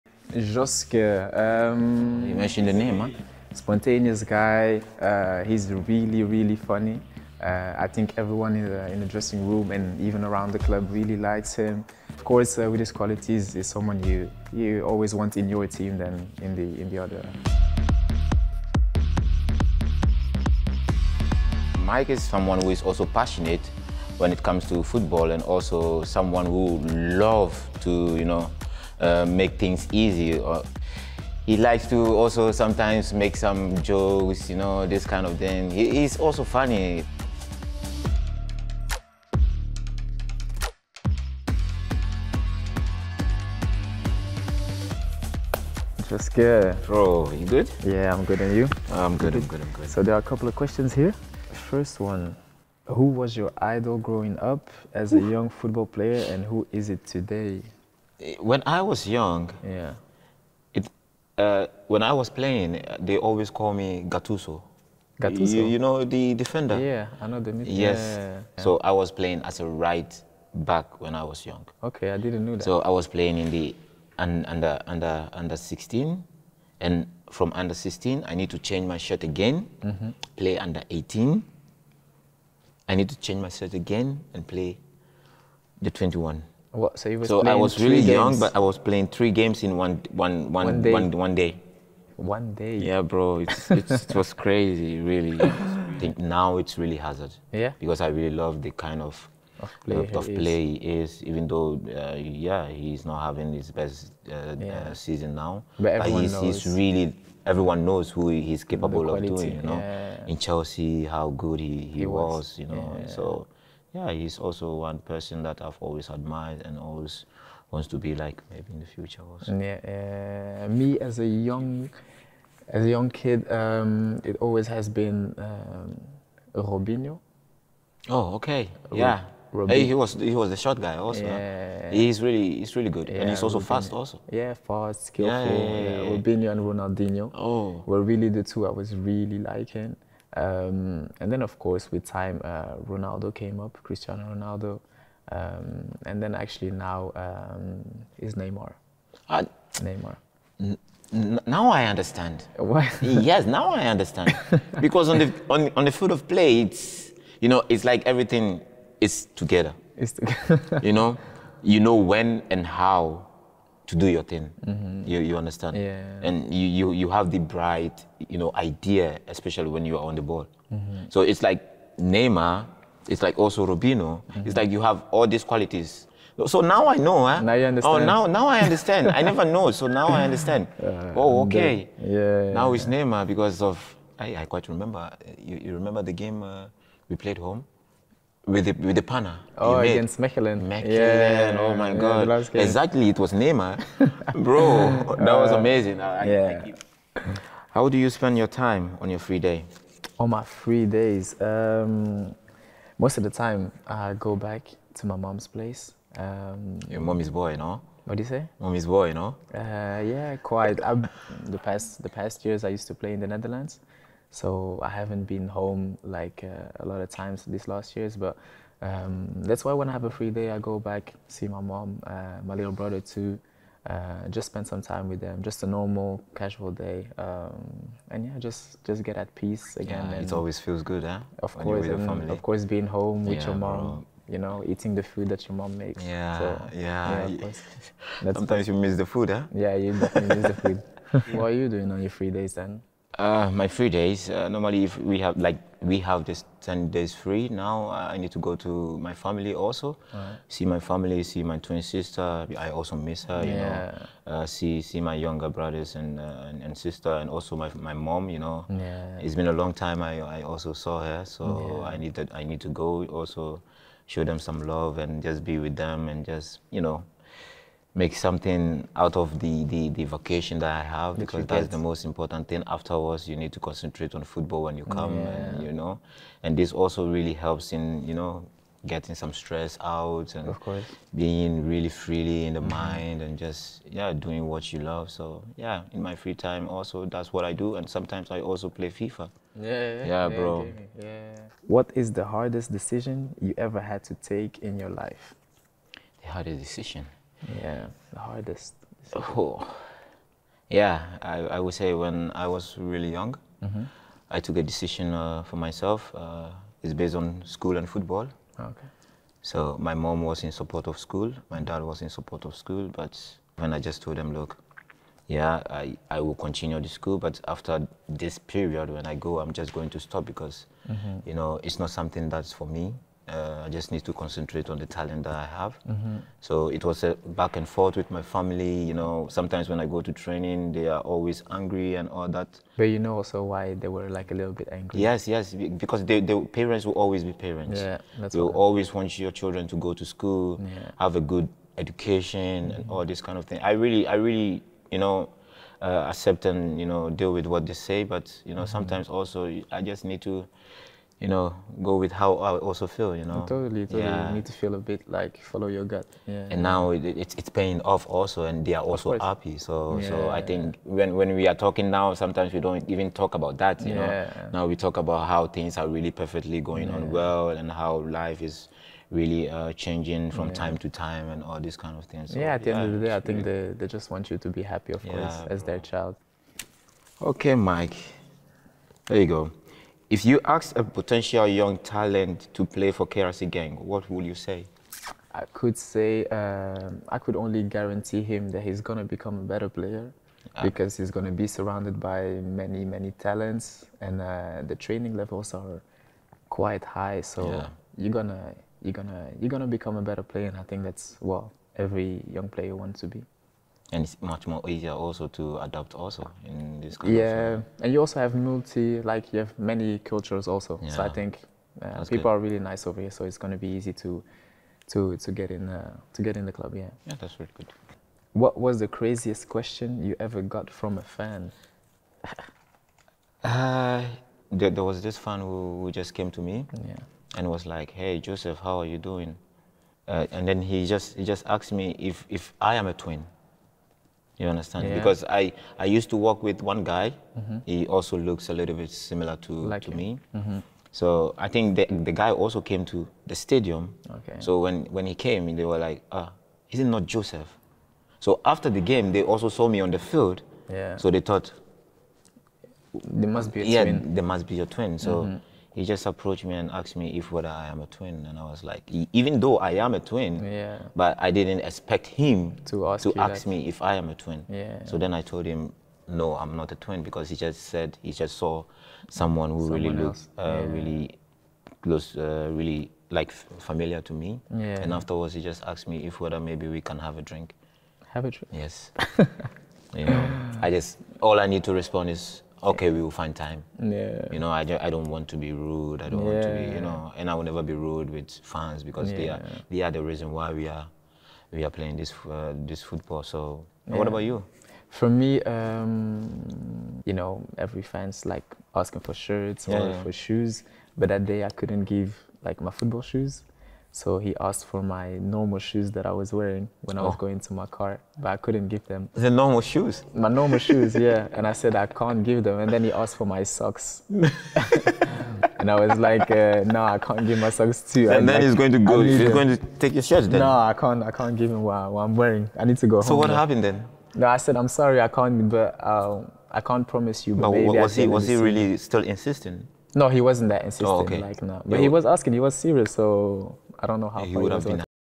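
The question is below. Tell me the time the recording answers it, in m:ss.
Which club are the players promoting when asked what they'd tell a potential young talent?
6:23.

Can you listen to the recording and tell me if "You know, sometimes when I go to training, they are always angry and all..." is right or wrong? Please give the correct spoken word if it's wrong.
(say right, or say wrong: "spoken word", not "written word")
right.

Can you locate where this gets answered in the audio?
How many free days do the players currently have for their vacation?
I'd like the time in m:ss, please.
4:06.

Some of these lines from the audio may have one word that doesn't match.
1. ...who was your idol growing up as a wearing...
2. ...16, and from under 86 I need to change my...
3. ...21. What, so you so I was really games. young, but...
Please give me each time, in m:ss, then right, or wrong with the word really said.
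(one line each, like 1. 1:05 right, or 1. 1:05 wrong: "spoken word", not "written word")
1. 0:52 wrong: "young", not "wearing"
2. 1:15 wrong: "16", not "86"
3. 1:25 right.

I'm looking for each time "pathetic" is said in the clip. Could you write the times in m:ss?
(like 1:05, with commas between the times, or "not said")
not said.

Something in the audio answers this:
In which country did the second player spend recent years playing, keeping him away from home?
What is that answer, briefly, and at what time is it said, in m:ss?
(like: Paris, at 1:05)
Netherlands, at 3:33.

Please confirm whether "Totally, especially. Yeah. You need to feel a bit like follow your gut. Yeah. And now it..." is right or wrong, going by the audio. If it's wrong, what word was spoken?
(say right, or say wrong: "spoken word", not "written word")
wrong: "totally", not "especially".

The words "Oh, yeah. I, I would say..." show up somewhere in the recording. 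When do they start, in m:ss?
4:59.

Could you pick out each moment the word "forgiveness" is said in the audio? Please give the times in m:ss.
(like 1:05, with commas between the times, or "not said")
not said.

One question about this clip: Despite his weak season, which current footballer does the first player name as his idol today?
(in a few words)
Hazard.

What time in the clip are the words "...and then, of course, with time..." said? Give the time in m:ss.
2:21.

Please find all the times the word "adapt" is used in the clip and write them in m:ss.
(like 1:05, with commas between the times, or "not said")
6:45.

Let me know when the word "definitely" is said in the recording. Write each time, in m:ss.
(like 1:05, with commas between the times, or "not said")
3:59.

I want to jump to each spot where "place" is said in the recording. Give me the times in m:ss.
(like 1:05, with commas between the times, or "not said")
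3:25.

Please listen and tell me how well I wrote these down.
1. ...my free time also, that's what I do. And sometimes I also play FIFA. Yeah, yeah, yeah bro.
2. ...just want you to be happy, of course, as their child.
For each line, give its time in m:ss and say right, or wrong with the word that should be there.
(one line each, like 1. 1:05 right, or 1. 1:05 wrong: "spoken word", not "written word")
1. 4:46 right
2. 6:13 right.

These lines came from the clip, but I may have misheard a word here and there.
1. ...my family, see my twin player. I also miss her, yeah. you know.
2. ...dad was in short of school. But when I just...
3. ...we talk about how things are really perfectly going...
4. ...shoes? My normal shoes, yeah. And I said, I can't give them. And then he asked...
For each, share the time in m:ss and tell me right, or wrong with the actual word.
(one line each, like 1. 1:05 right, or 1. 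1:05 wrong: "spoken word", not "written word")
1. 4:10 wrong: "sister", not "player"
2. 5:11 wrong: "support", not "short"
3. 6:04 right
4. 8:29 right.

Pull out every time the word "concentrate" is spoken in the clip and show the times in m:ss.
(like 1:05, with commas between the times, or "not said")
4:33, 5:24.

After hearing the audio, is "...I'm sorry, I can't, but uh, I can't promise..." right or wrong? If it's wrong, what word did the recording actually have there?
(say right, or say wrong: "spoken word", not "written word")
right.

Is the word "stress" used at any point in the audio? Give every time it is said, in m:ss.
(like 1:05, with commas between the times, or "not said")
4:39.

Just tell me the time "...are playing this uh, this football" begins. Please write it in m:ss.
8:11.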